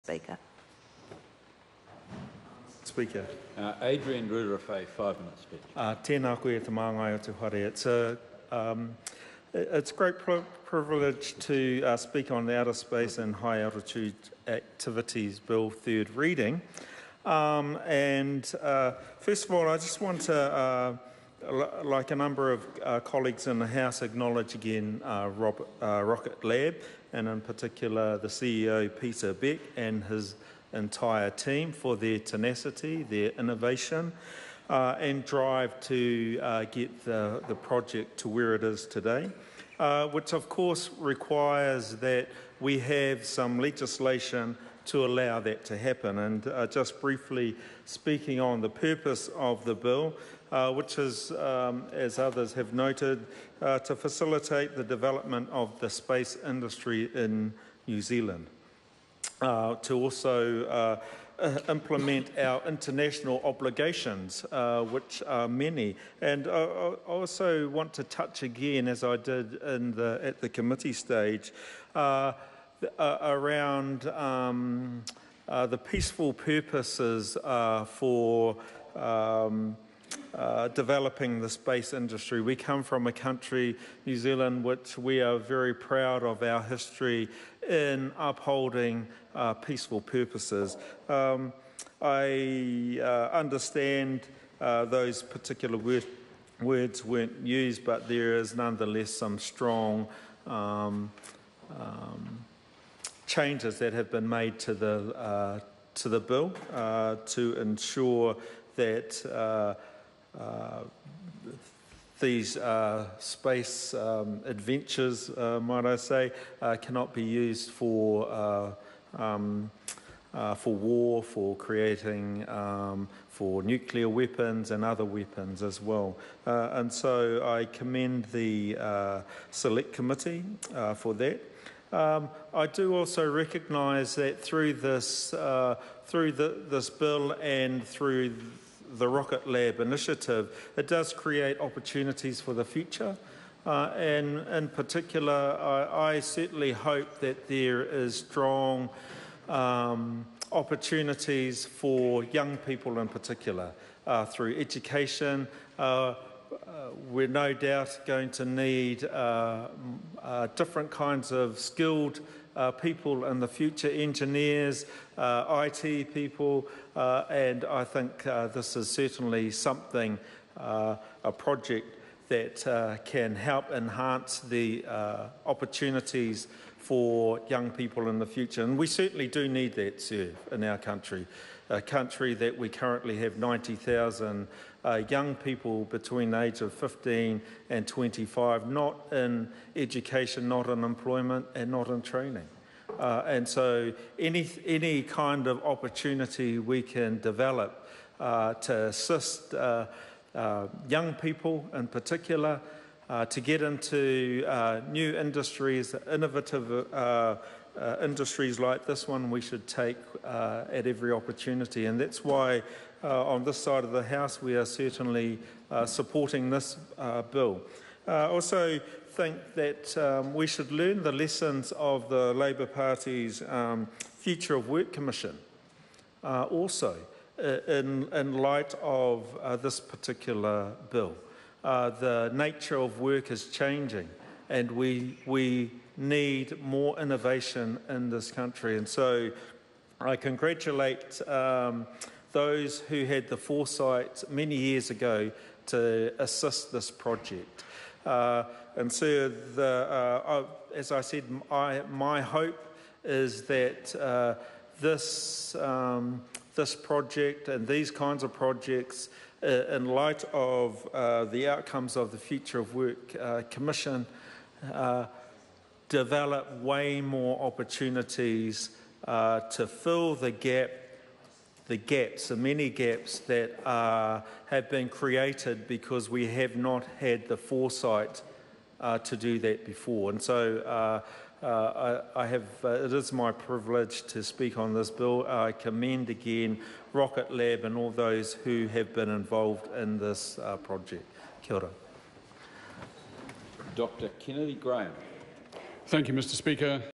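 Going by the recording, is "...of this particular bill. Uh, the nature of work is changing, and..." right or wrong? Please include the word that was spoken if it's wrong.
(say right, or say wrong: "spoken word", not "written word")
right.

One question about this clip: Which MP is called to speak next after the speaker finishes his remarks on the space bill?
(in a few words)
Dr Kennedy Graham.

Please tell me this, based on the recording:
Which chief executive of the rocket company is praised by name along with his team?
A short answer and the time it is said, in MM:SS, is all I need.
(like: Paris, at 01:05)
Peter Beck, at 00:28.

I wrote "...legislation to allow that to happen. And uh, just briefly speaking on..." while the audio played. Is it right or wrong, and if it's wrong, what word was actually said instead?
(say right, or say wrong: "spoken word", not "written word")
right.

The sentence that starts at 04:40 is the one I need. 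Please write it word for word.
And so uh, uh, I, I, have, uh, it is my privilege to speak on this bill.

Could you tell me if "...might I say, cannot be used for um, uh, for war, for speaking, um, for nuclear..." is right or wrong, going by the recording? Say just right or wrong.
wrong.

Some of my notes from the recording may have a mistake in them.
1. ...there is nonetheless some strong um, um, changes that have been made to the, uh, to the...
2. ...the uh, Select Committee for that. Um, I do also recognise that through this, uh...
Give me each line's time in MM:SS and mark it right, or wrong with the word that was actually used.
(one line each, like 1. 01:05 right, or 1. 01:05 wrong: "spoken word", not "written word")
1. 01:38 right
2. 02:08 right.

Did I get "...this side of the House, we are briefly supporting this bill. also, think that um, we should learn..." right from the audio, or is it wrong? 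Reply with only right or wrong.
wrong.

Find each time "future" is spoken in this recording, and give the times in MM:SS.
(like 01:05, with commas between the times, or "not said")
02:22, 02:43, 02:58, 03:44, 04:22.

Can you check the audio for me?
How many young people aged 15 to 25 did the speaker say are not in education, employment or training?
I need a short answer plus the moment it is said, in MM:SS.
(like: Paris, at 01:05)
90,000, at 03:03.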